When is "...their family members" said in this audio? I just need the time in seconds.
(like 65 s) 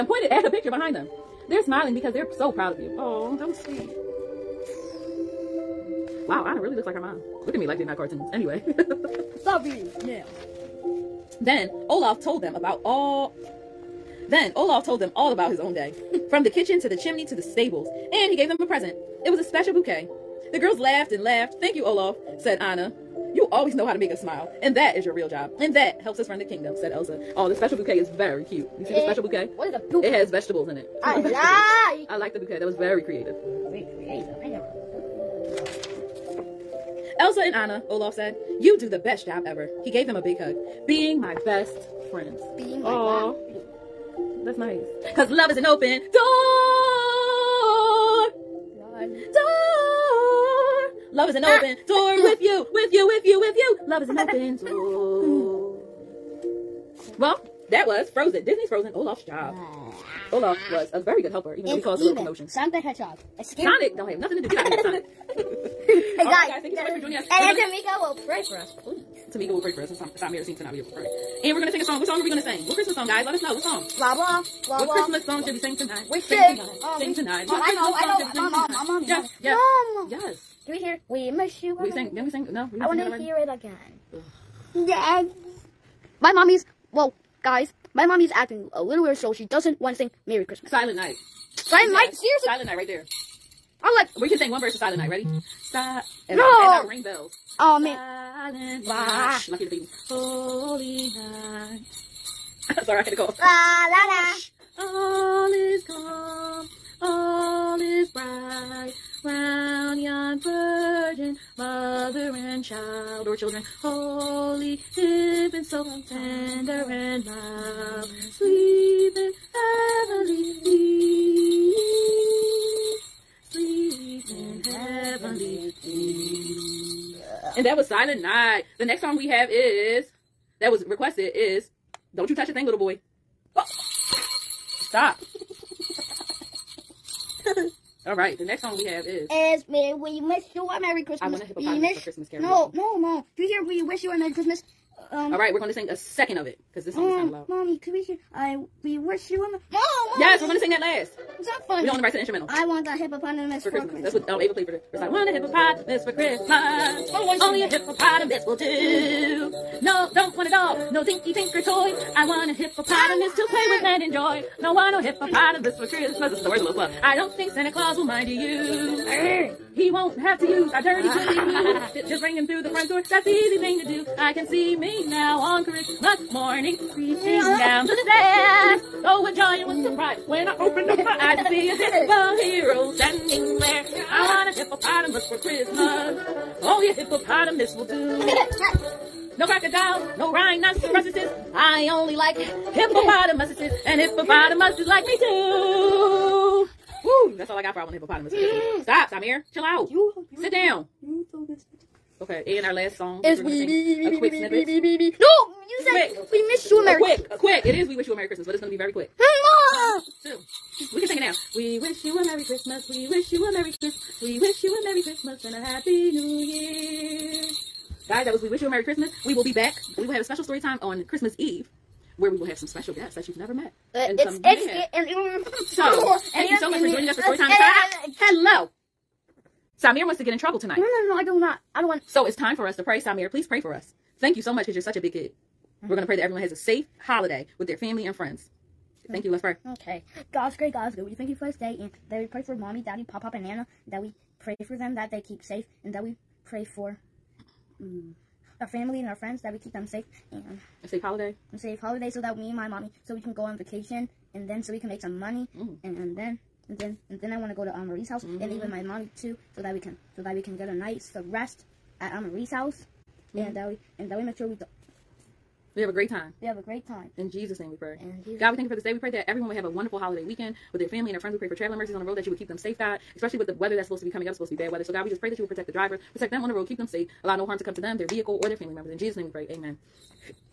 278 s.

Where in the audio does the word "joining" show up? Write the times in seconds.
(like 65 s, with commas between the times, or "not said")
66 s, 226 s.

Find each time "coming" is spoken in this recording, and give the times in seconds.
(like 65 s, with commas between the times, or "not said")
274 s.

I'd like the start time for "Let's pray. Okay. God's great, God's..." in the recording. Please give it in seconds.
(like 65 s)
239 s.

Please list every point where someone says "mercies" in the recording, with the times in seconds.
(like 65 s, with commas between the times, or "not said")
271 s.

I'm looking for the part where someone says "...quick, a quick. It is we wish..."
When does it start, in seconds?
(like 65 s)
207 s.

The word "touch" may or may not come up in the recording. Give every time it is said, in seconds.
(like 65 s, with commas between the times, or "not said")
132 s.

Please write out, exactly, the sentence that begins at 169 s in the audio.
He won't have to use our dirty booty ah.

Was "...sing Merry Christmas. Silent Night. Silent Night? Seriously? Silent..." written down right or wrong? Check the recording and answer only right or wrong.
right.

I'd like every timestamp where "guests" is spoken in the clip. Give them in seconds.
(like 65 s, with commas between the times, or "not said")
222 s.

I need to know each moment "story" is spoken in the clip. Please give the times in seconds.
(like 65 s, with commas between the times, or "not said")
220 s, 227 s.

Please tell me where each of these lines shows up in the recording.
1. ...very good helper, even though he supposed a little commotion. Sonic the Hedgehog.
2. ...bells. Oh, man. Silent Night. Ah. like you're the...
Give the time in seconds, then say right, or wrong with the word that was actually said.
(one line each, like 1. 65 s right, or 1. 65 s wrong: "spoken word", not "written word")
1. 61 s wrong: "caused", not "supposed"
2. 97 s right.